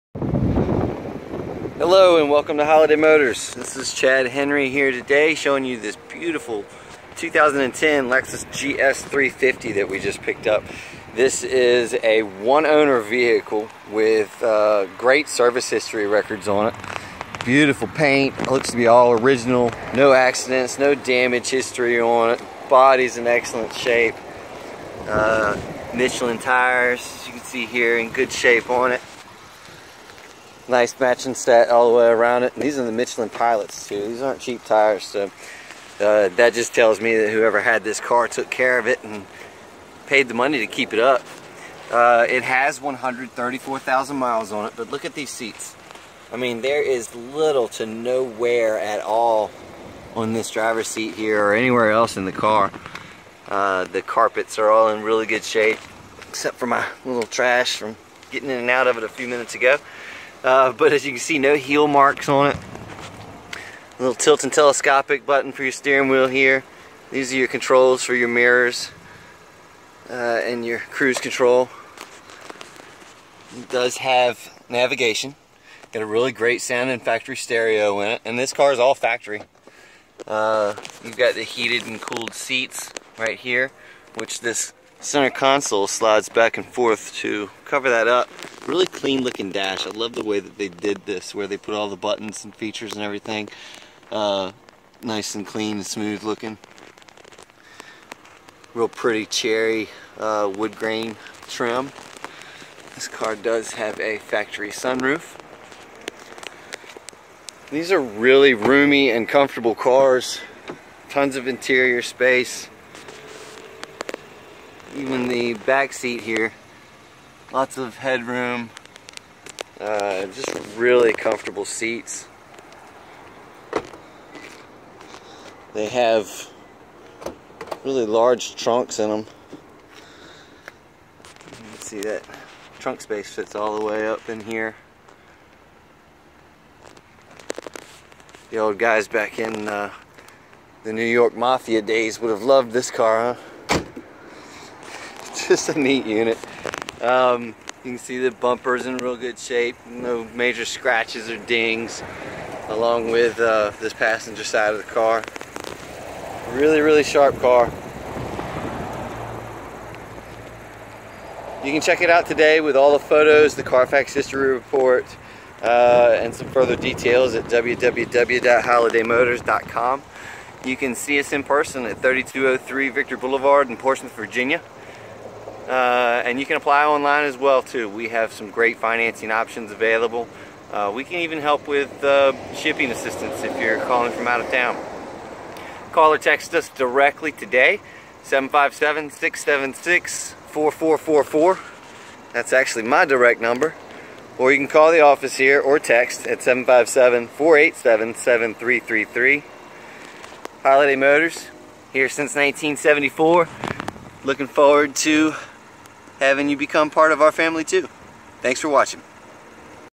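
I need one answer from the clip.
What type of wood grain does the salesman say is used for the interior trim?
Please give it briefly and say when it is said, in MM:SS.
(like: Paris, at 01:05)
Cherry, at 01:39.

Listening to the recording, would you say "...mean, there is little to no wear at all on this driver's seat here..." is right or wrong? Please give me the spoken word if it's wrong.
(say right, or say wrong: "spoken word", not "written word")
right.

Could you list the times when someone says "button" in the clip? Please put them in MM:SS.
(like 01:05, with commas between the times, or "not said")
01:05, 01:31.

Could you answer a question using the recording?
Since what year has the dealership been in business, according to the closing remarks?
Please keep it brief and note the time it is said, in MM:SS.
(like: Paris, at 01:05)
1974, at 03:22.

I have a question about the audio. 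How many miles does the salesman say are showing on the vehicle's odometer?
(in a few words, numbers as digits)
134,000.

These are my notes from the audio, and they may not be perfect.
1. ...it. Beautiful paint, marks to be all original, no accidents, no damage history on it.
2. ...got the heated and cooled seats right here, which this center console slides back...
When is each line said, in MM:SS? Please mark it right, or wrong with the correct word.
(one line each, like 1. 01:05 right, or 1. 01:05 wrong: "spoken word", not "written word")
1. 00:16 wrong: "looks", not "marks"
2. 01:21 right.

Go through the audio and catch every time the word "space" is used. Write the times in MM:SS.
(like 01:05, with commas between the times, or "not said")
01:52, 02:12.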